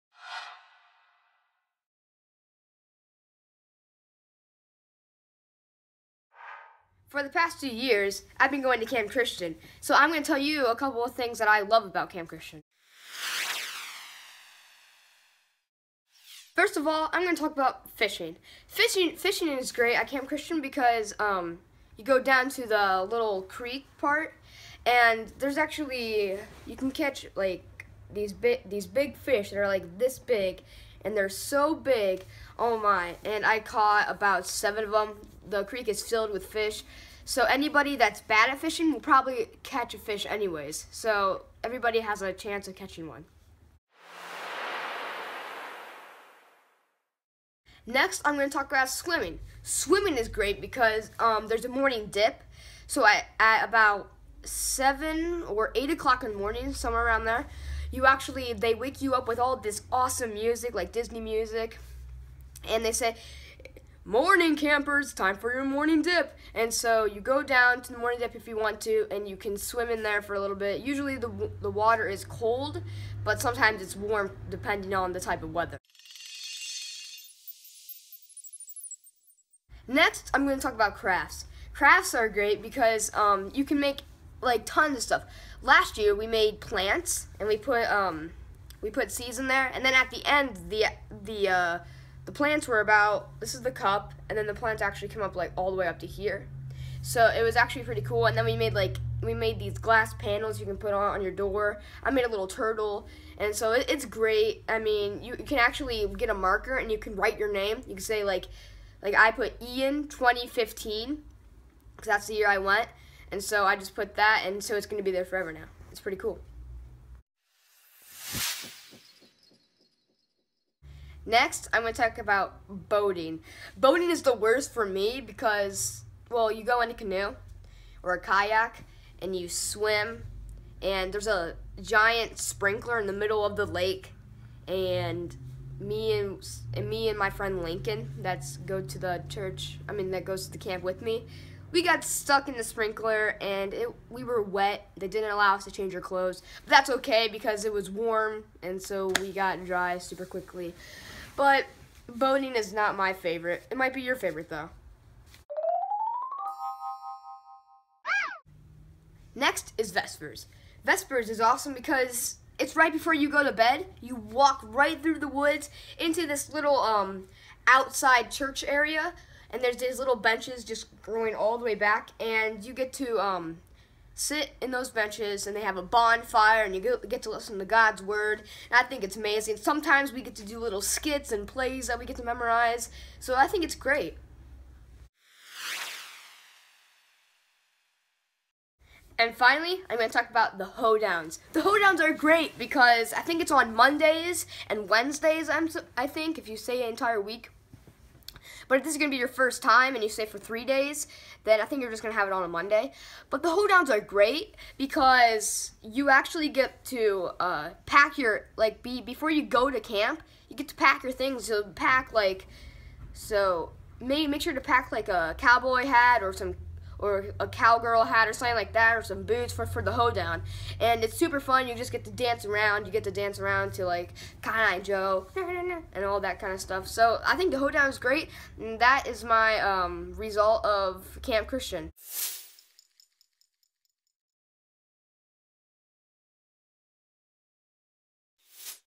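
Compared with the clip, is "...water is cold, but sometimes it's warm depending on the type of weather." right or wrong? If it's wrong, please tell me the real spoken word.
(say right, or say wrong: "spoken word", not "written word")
right.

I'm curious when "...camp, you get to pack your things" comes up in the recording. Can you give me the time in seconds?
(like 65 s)
209 s.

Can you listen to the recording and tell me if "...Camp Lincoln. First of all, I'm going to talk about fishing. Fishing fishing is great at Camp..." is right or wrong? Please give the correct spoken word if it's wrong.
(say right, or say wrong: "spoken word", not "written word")
wrong: "Christian", not "Lincoln".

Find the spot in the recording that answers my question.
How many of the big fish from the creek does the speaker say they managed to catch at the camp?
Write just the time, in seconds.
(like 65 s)
34 s.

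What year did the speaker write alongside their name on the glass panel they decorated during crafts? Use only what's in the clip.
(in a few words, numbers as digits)
2015.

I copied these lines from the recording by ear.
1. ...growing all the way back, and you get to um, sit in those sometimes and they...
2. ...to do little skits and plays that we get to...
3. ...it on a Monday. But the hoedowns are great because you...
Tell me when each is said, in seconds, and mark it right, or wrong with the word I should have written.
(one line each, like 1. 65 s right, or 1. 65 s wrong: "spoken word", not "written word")
1. 171 s wrong: "benches", not "sometimes"
2. 180 s right
3. 202 s right.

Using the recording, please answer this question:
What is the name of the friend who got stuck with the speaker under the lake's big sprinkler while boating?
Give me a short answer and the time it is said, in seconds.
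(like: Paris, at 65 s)
Lincoln, at 137 s.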